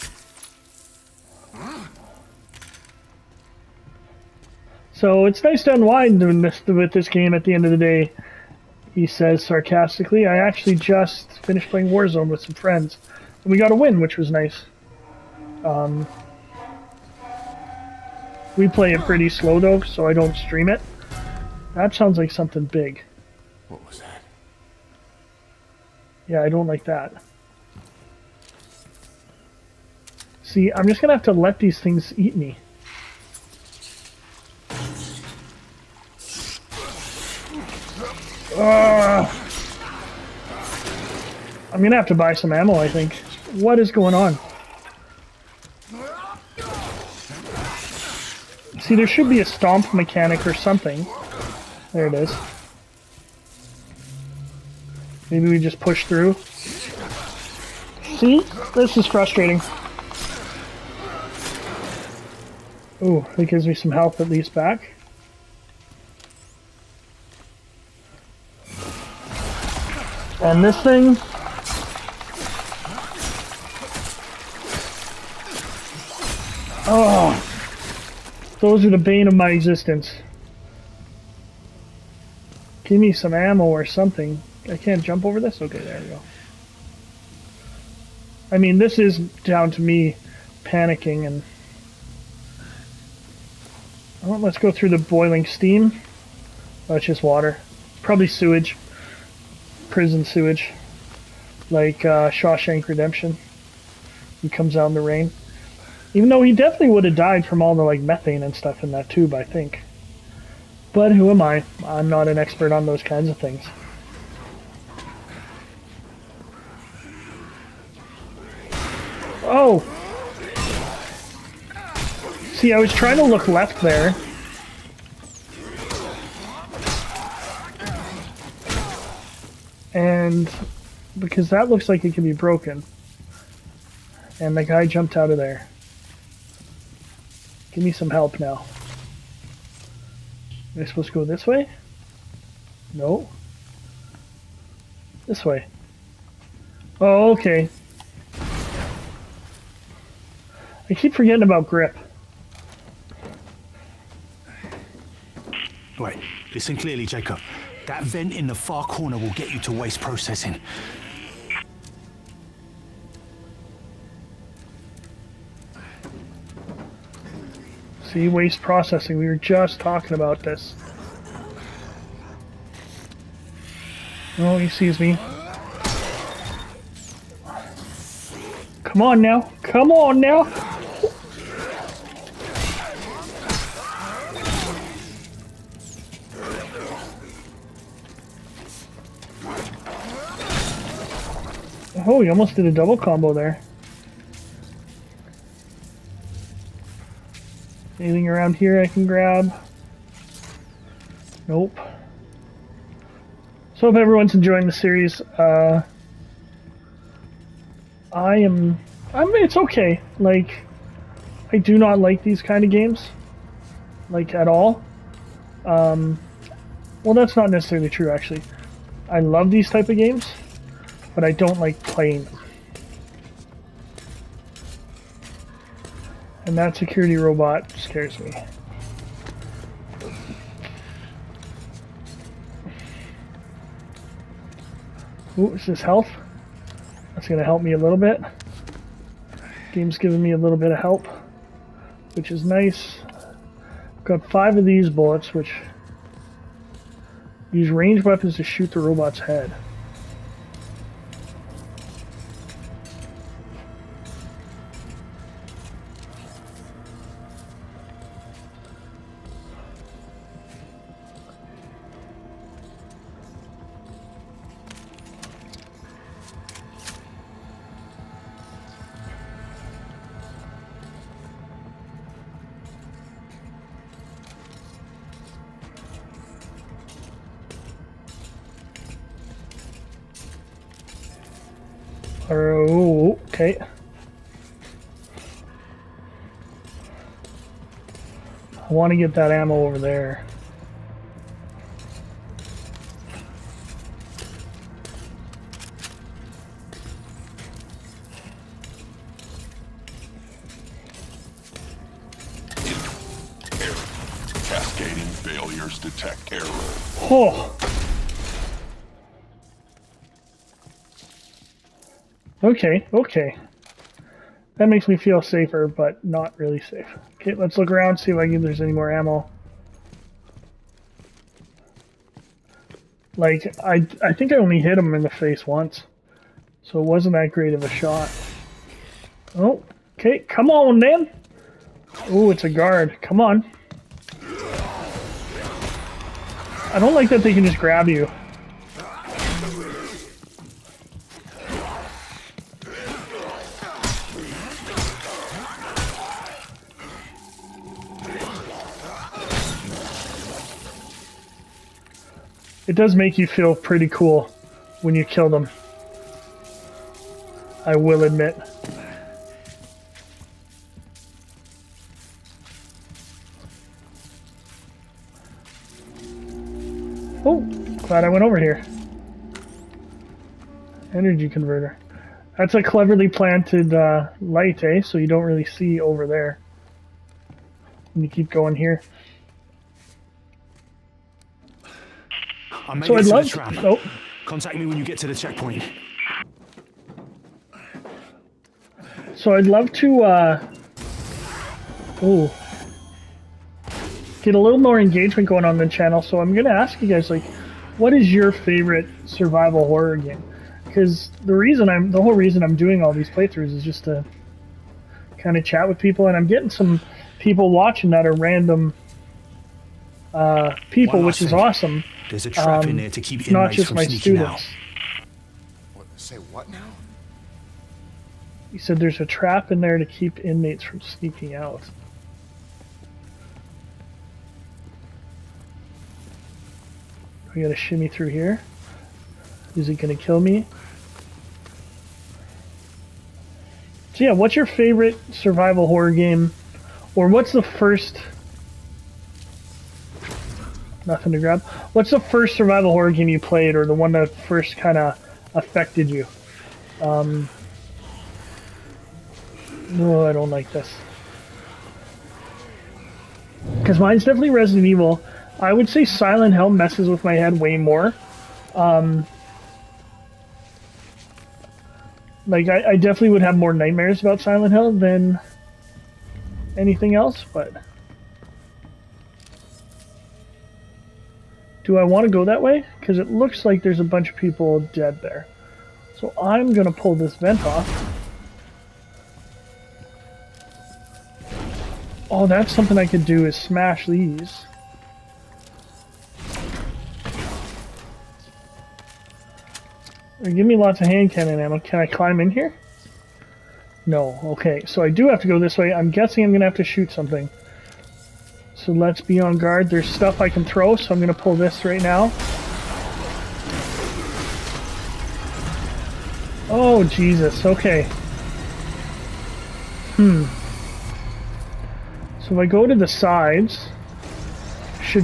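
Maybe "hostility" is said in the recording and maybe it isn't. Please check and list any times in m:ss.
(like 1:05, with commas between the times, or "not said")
not said.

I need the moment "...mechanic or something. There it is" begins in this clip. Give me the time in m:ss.
0:49.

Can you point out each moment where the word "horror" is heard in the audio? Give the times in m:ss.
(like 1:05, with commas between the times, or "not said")
6:39, 7:15, 7:22.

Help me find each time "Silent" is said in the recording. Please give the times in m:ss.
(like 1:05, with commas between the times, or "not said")
7:35, 7:44.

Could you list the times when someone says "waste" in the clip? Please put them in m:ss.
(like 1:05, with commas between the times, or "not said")
2:39, 2:48.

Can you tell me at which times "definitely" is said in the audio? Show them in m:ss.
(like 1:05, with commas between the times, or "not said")
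1:46, 7:34, 7:42.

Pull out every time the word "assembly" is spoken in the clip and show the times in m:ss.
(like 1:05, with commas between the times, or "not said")
not said.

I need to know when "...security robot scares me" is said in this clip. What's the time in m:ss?
3:46.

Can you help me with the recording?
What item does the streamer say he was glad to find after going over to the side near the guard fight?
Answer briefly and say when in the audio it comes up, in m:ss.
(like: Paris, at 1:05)
Energy converter, at 6:10.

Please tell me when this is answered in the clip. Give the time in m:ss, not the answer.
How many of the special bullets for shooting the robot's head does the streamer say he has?
4:04.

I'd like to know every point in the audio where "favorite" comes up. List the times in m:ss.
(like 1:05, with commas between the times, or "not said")
6:38, 7:14.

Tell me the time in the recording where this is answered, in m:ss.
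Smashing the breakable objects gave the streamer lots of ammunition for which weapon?
8:10.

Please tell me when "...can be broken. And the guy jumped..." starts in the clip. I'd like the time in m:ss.
2:12.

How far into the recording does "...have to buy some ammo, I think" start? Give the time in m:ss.
0:41.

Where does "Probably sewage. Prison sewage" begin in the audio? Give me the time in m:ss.
1:38.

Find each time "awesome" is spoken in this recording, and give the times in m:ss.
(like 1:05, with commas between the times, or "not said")
6:51.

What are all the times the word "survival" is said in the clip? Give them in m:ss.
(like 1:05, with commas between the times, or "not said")
6:39, 7:15, 7:22.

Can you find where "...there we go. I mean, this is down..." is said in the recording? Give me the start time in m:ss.
1:25.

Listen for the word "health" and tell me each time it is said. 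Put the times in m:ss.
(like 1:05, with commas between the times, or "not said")
1:03, 3:55.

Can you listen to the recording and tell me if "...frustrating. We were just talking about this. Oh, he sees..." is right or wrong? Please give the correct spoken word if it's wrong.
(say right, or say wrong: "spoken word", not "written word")
wrong: "processing", not "frustrating".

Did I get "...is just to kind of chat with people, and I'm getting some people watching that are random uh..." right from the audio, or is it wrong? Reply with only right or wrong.
right.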